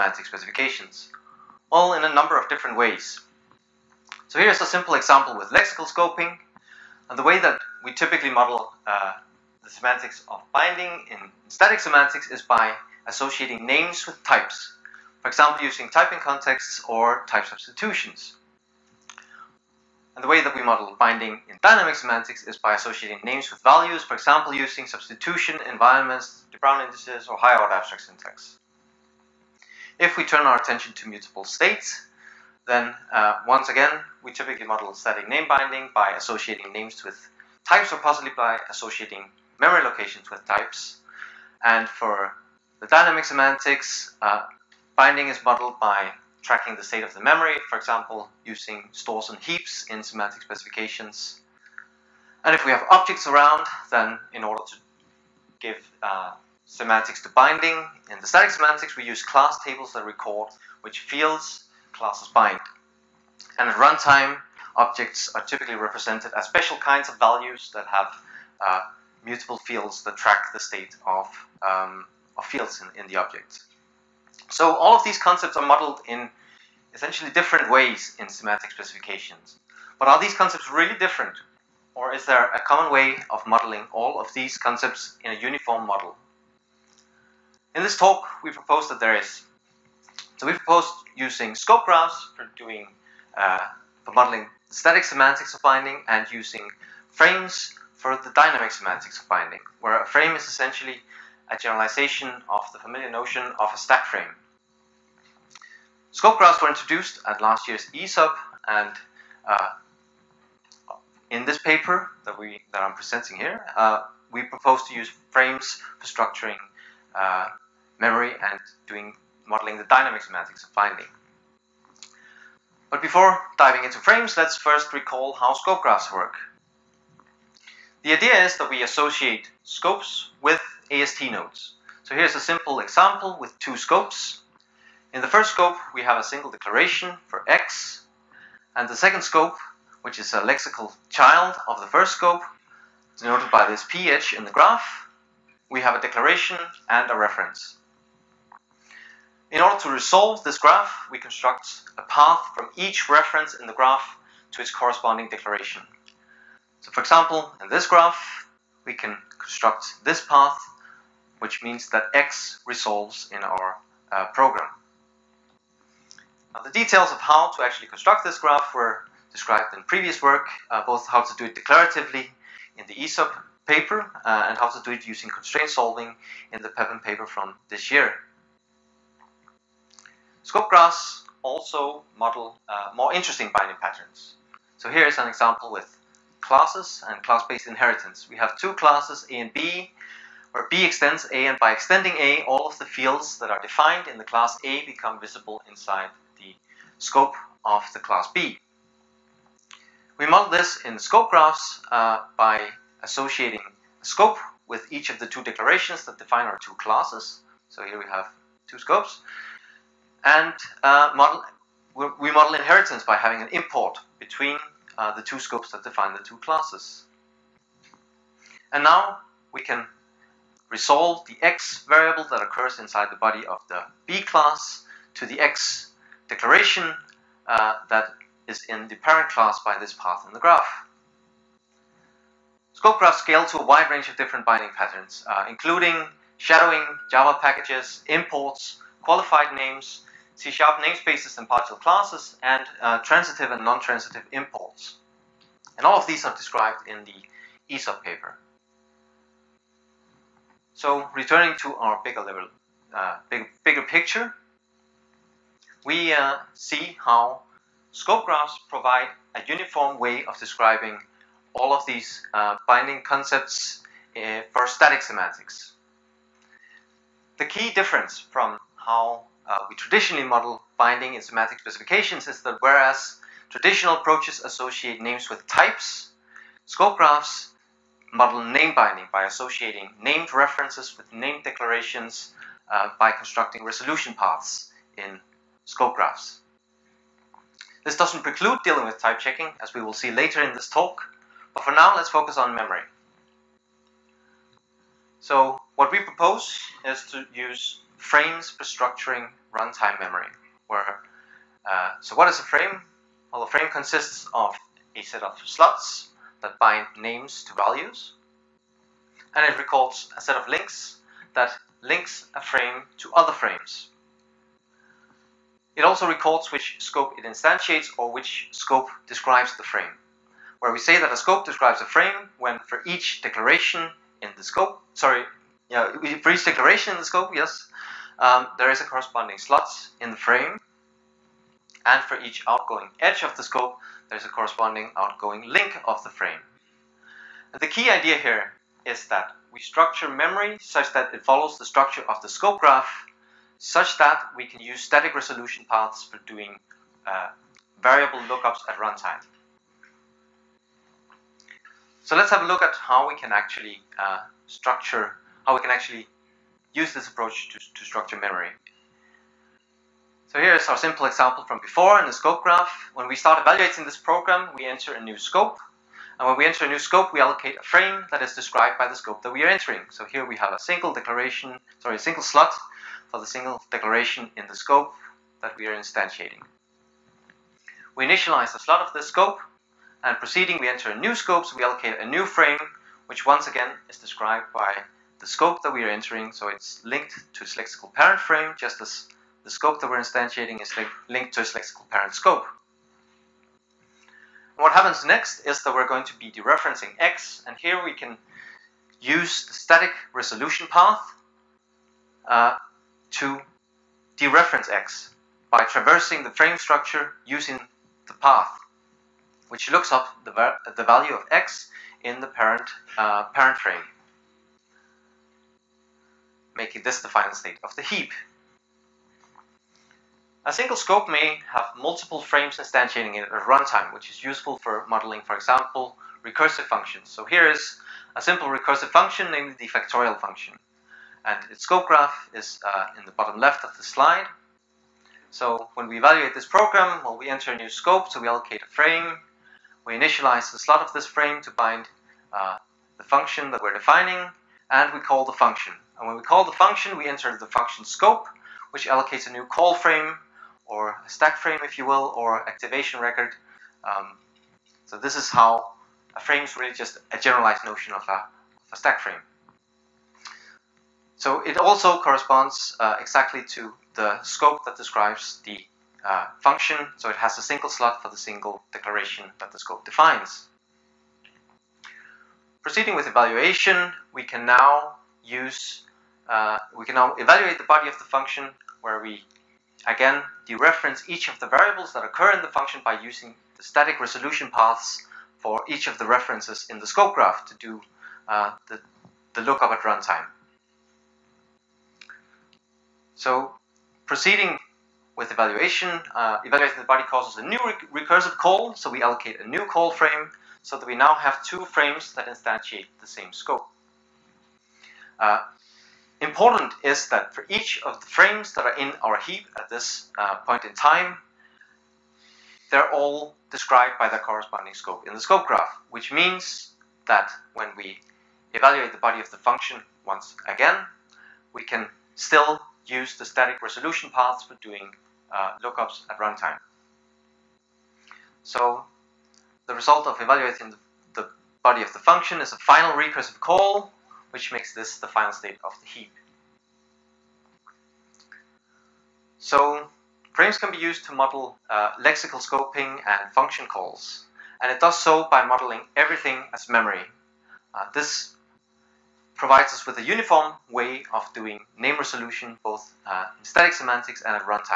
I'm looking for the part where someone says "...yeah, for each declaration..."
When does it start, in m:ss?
5:25.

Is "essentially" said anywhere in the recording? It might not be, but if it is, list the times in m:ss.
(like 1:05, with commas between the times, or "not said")
1:16, 1:40.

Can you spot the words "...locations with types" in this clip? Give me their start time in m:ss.
0:39.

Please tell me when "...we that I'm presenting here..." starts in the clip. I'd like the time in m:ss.
1:52.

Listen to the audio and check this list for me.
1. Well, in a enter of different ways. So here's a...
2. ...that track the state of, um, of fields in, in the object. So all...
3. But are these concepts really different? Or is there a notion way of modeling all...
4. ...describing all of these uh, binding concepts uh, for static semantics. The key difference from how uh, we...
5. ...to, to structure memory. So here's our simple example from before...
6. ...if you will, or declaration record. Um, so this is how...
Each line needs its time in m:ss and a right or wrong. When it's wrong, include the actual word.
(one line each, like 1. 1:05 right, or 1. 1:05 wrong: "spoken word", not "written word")
1. 0:01 wrong: "number", not "enter"
2. 1:10 right
3. 1:19 wrong: "common", not "notion"
4. 4:20 right
5. 5:57 right
6. 7:31 wrong: "activation", not "declaration".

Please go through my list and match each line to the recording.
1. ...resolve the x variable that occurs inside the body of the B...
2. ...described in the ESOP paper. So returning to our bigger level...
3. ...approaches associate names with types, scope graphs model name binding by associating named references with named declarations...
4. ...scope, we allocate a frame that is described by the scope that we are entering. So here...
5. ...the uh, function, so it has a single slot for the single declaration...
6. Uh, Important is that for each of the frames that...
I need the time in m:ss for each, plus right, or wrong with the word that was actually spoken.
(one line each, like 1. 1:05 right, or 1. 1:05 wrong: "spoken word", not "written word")
1. 3:40 right
2. 4:06 right
3. 4:33 right
4. 6:06 right
5. 7:45 right
6. 8:25 right.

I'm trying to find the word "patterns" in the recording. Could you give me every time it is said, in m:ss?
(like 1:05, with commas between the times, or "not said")
3:03, 3:54.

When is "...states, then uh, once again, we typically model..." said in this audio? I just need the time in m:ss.
0:31.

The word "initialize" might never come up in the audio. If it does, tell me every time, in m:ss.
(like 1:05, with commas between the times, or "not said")
6:18, 7:19.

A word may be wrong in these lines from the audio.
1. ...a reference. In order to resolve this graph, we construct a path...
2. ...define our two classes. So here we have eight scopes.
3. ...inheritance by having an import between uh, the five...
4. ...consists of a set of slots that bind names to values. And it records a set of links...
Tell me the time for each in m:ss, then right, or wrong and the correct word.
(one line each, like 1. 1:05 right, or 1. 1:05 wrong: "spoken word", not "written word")
1. 2:27 right
2. 3:26 wrong: "two", not "eight"
3. 3:32 wrong: "two", not "five"
4. 5:03 right.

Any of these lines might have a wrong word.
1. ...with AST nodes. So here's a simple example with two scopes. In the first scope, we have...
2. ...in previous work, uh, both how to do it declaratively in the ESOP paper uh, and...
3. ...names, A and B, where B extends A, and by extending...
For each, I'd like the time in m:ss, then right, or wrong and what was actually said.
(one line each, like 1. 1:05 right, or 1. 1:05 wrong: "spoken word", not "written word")
1. 2:10 right
2. 2:49 right
3. 3:08 wrong: "classes", not "names".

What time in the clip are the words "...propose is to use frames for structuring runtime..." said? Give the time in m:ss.
4:55.